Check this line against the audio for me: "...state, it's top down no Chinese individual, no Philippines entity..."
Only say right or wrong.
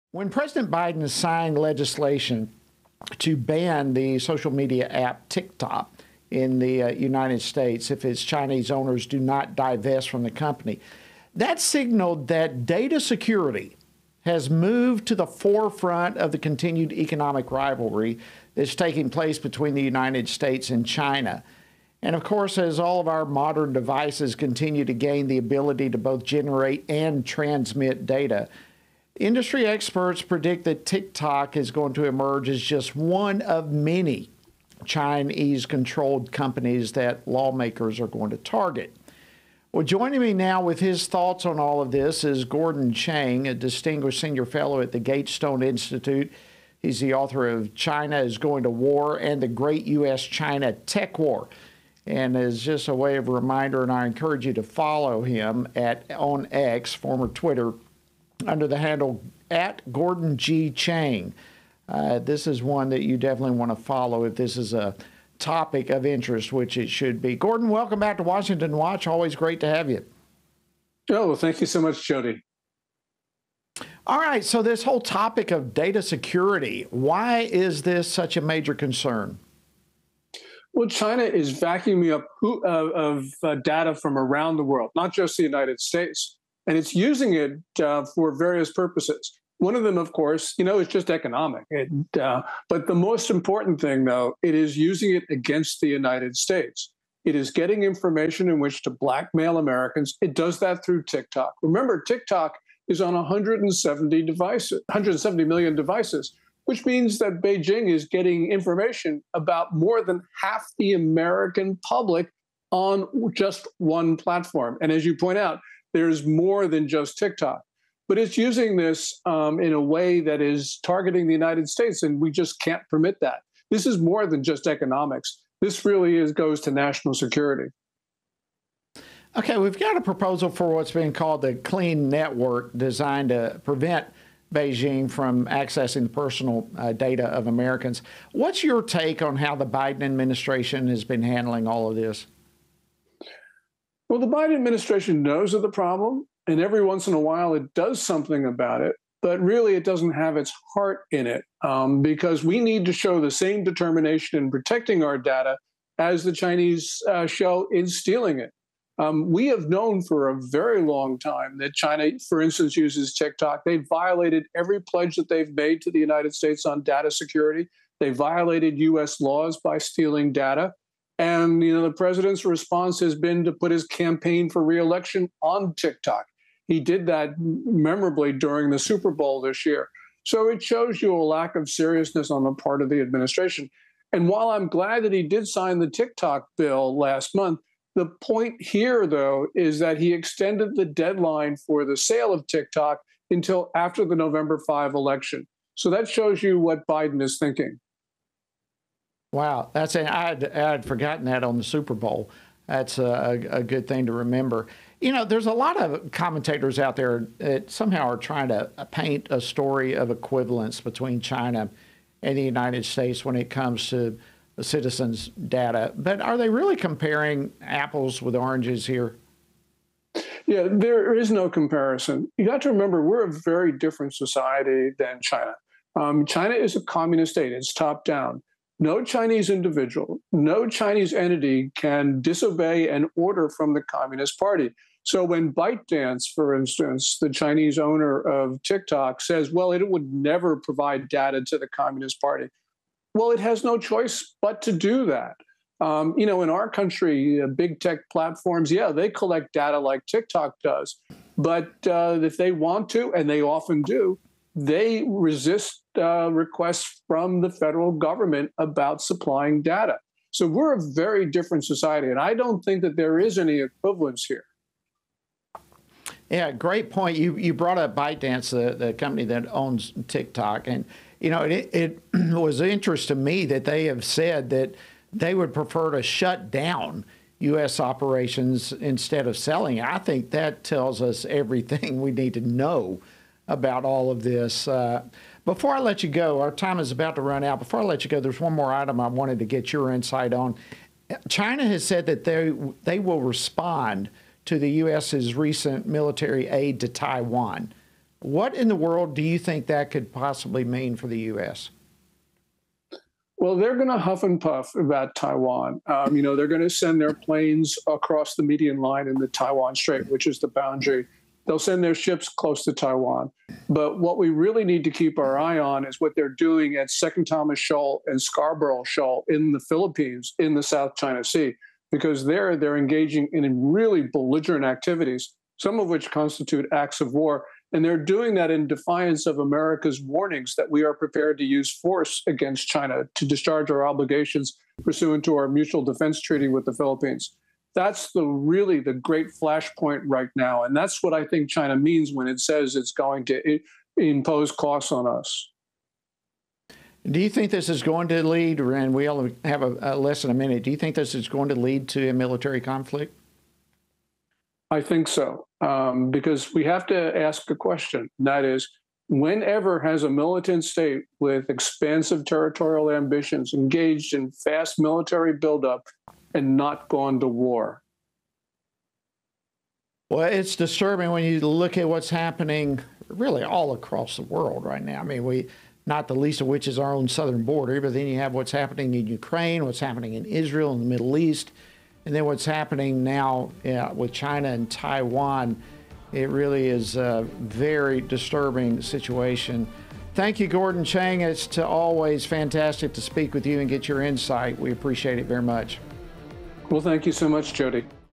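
wrong.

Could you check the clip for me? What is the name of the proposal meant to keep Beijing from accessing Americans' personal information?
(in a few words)
Clean Network.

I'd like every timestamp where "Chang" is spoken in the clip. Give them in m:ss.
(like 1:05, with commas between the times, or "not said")
0:42, 1:00, 6:30.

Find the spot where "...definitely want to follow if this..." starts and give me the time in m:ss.
1:03.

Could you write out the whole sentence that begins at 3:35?
But are they really comparing apples with oranges here?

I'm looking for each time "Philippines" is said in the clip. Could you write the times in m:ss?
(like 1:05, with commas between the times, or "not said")
5:19, 5:36.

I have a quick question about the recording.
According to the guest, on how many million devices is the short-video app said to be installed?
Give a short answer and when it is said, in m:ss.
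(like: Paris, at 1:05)
170 million, at 1:44.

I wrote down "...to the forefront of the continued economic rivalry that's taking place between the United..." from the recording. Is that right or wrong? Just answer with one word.
right.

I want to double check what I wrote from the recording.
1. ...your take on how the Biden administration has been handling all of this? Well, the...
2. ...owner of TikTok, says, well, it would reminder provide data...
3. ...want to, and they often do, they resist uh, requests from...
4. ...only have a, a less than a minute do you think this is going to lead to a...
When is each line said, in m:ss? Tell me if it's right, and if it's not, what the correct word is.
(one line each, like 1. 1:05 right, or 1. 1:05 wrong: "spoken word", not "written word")
1. 2:18 right
2. 3:57 wrong: "never", not "reminder"
3. 4:12 right
4. 5:49 right.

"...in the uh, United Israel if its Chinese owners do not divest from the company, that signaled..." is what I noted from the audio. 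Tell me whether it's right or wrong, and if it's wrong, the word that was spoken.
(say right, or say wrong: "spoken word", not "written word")
wrong: "States", not "Israel".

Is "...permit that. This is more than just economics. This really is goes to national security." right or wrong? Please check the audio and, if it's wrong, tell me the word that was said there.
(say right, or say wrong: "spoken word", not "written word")
right.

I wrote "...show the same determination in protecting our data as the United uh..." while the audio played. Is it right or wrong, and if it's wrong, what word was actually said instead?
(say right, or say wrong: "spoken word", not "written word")
wrong: "Chinese", not "United".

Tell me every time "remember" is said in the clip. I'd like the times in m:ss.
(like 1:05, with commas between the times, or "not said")
1:41, 3:24, 3:42.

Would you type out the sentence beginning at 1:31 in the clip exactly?
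It, uh, but the most important thing, though, it is using it against the United States.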